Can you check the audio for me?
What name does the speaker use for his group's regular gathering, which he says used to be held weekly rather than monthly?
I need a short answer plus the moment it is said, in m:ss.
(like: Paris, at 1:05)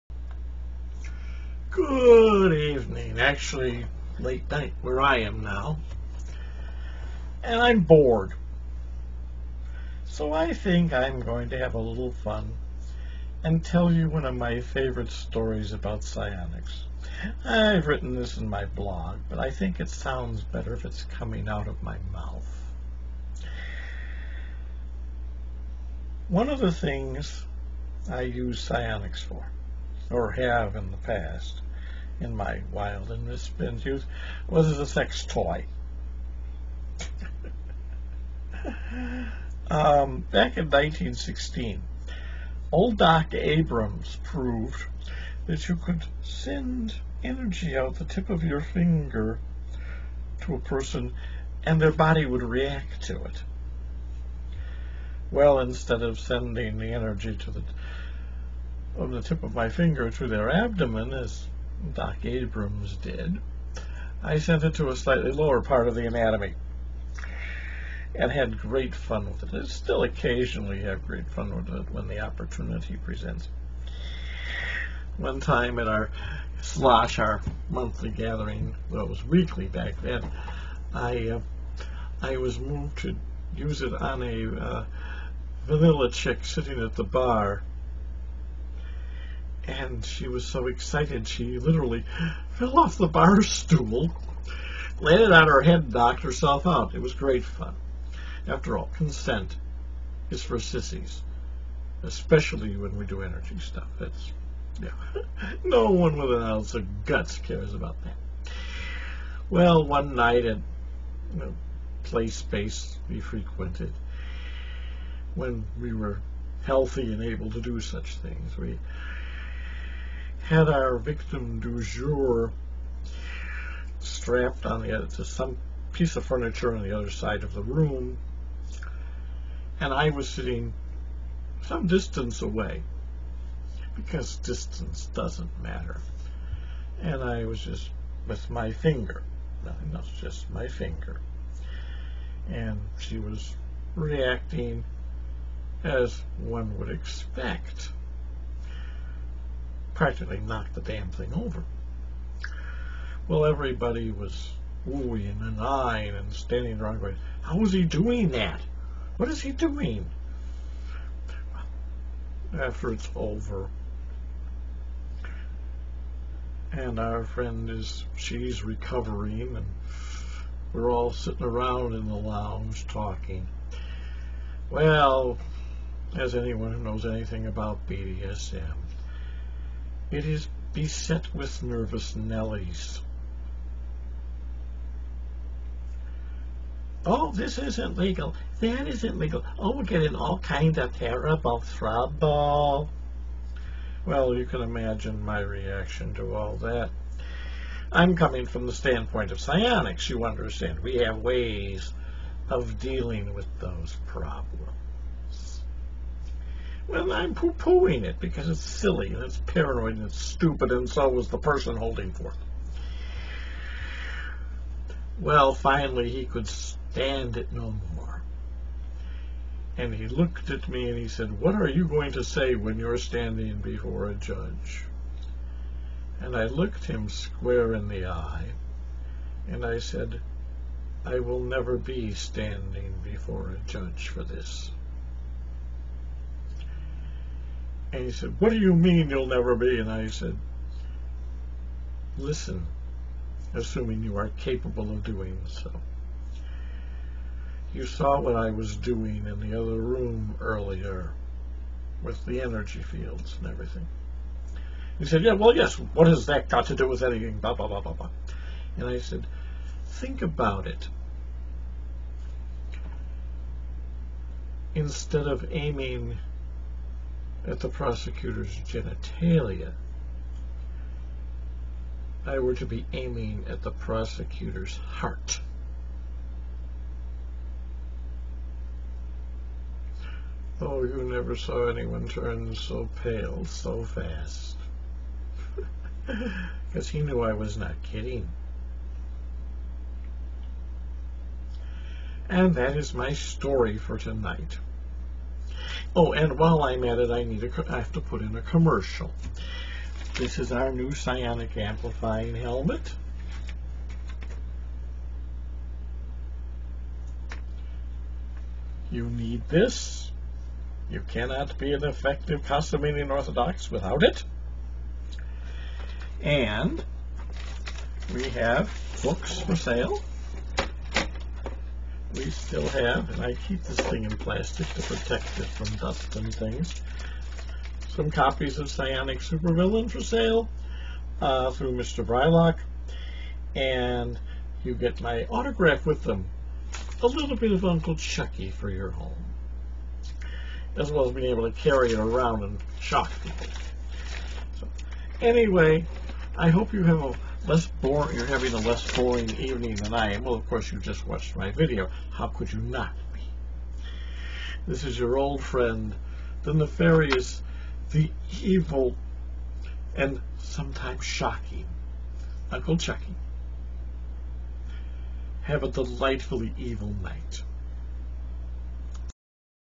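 slosh, at 1:16.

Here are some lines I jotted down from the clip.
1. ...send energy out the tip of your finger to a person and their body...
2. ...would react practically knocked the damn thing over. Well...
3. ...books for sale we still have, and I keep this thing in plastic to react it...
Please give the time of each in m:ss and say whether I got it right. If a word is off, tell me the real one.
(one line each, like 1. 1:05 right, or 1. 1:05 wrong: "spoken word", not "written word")
1. 0:46 right
2. 2:26 wrong: "expect", not "react"
3. 5:19 wrong: "protect", not "react".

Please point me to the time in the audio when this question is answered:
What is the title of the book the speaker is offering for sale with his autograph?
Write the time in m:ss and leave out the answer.
5:28.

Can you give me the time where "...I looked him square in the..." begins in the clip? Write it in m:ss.
3:46.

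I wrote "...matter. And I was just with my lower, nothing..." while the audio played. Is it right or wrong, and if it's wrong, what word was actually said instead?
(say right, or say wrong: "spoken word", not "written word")
wrong: "finger", not "lower".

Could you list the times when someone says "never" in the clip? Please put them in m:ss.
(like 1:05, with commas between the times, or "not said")
3:51, 3:59, 4:41.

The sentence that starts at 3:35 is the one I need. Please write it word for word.
Well, finally, he could stand it no more.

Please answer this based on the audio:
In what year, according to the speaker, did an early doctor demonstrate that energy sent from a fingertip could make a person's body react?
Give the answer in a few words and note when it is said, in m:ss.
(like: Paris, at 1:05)
1916, at 0:40.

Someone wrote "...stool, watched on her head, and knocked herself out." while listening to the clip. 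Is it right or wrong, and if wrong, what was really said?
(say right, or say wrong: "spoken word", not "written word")
wrong: "landed", not "watched".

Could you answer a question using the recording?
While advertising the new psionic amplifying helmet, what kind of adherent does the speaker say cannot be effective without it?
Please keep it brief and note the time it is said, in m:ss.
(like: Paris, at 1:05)
Cosimanian Orthodox, at 5:12.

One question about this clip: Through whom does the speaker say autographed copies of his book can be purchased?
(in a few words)
Mr. Brylock.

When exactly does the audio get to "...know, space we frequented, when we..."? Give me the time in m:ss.
1:52.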